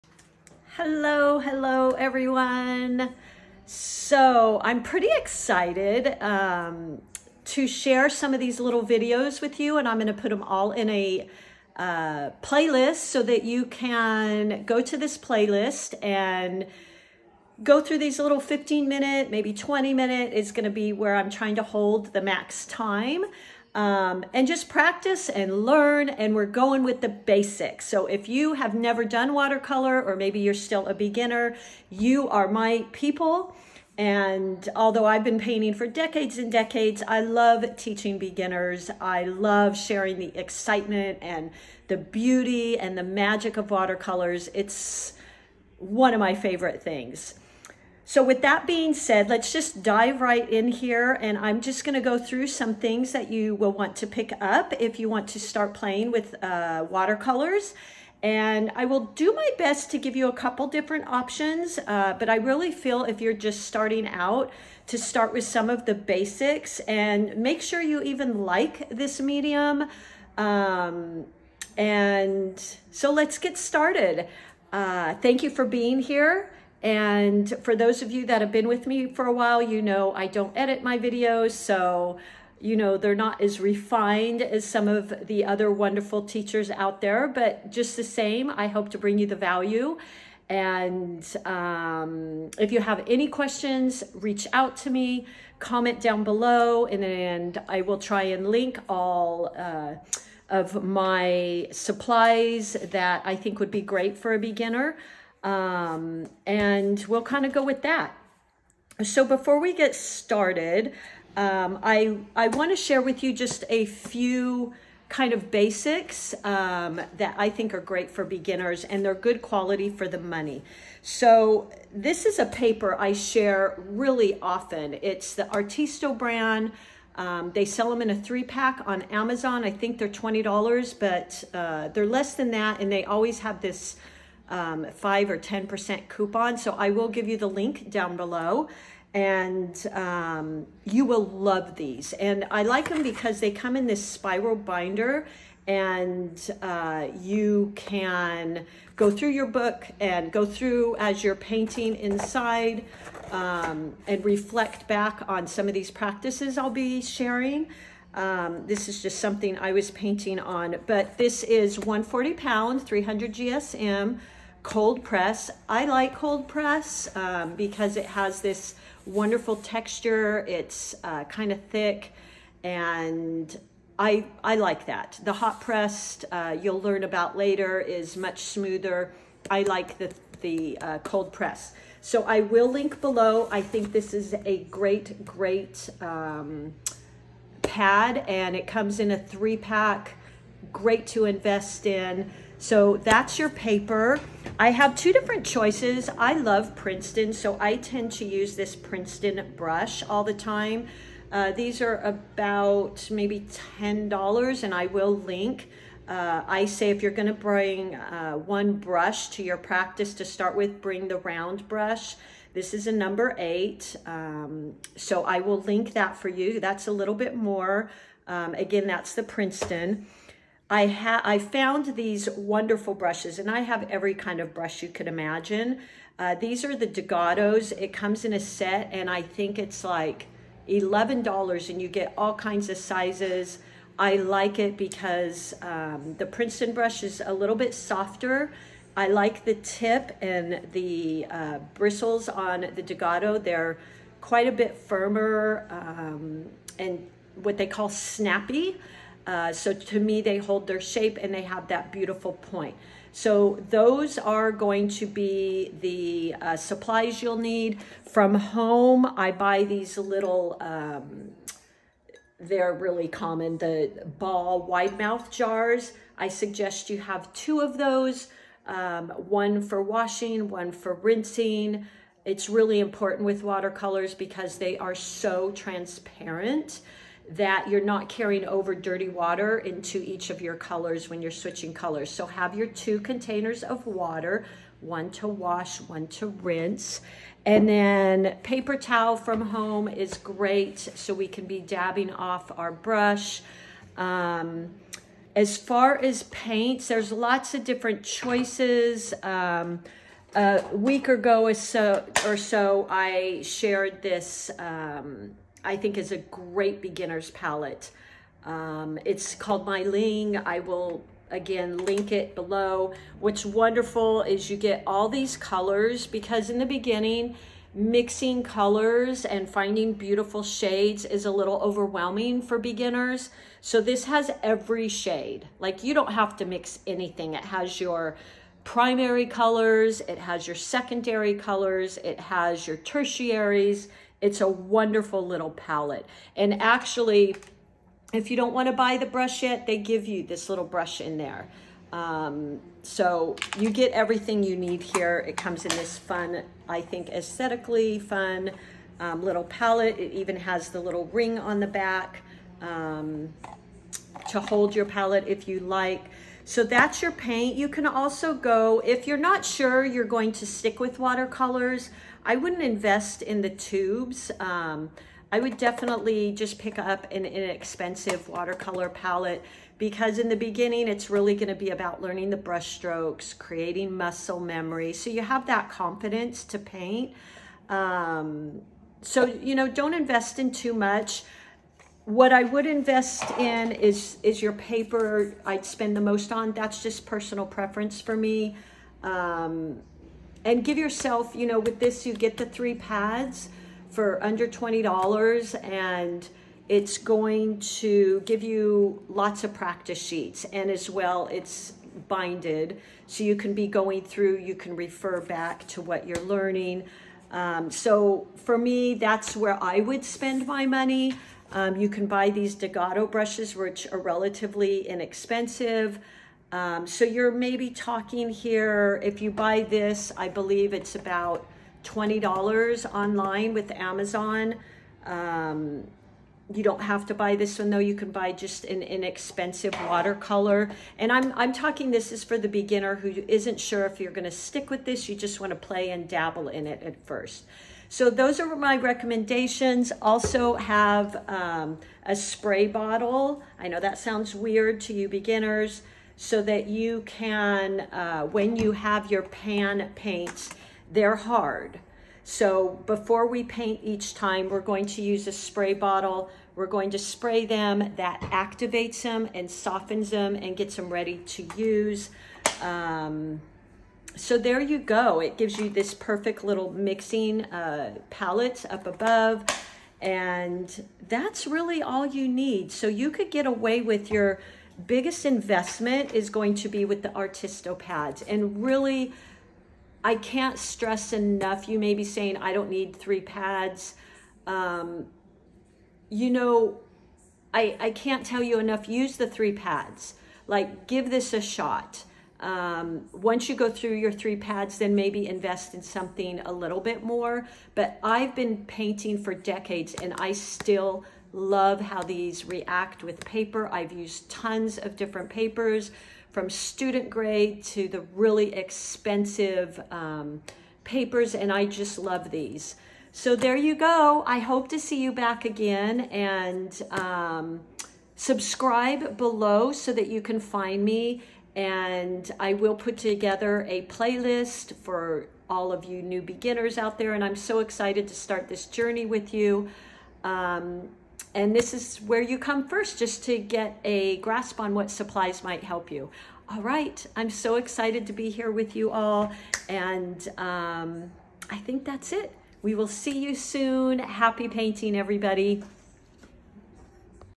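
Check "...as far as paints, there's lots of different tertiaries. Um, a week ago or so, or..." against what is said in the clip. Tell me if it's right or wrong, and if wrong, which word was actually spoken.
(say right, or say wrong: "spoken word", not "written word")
wrong: "choices", not "tertiaries".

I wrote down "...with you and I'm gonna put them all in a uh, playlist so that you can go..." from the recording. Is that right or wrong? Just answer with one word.
right.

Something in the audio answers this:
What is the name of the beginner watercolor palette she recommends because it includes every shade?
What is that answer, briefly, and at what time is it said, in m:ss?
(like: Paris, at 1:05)
Meiliang, at 5:09.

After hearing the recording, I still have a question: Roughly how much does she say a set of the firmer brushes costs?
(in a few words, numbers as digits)
$11.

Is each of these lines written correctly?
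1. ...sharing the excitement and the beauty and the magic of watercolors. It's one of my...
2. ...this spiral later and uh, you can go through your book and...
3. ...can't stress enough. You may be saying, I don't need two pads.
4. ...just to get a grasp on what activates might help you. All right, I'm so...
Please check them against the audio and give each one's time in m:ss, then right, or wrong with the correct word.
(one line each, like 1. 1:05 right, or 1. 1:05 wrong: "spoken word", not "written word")
1. 0:39 right
2. 2:23 wrong: "binder", not "later"
3. 8:00 wrong: "three", not "two"
4. 8:52 wrong: "supplies", not "activates".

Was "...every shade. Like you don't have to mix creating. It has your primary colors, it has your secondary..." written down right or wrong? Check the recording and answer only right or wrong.
wrong.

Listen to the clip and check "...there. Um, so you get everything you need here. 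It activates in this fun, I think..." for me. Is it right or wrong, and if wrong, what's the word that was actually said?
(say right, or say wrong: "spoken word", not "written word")
wrong: "comes", not "activates".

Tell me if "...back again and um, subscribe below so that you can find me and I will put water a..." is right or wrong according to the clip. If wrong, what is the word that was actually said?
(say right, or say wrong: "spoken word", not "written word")
wrong: "together", not "water".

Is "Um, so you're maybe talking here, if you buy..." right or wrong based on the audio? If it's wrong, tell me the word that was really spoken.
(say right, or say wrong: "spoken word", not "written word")
right.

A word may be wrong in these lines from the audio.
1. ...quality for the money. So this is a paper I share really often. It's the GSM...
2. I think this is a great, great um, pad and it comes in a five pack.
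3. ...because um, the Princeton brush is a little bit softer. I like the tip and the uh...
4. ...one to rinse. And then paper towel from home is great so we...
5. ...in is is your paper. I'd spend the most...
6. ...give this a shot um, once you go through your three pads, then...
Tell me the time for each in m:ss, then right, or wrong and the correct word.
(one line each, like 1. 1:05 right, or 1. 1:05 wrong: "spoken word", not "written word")
1. 1:59 wrong: "Artisto", not "GSM"
2. 3:03 wrong: "three", not "five"
3. 3:54 right
4. 4:45 right
5. 6:23 right
6. 8:10 right.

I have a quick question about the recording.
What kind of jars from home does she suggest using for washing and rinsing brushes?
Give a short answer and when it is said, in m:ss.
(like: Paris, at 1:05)
Ball wide mouth jars, at 4:24.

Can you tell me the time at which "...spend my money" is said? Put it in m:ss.
6:50.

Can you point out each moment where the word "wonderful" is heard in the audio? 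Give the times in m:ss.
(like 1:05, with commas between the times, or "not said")
1:25, 2:49, 3:42, 5:13, 5:34.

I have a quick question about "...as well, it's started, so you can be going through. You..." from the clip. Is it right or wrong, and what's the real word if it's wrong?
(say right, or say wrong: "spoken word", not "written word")
wrong: "binded", not "started".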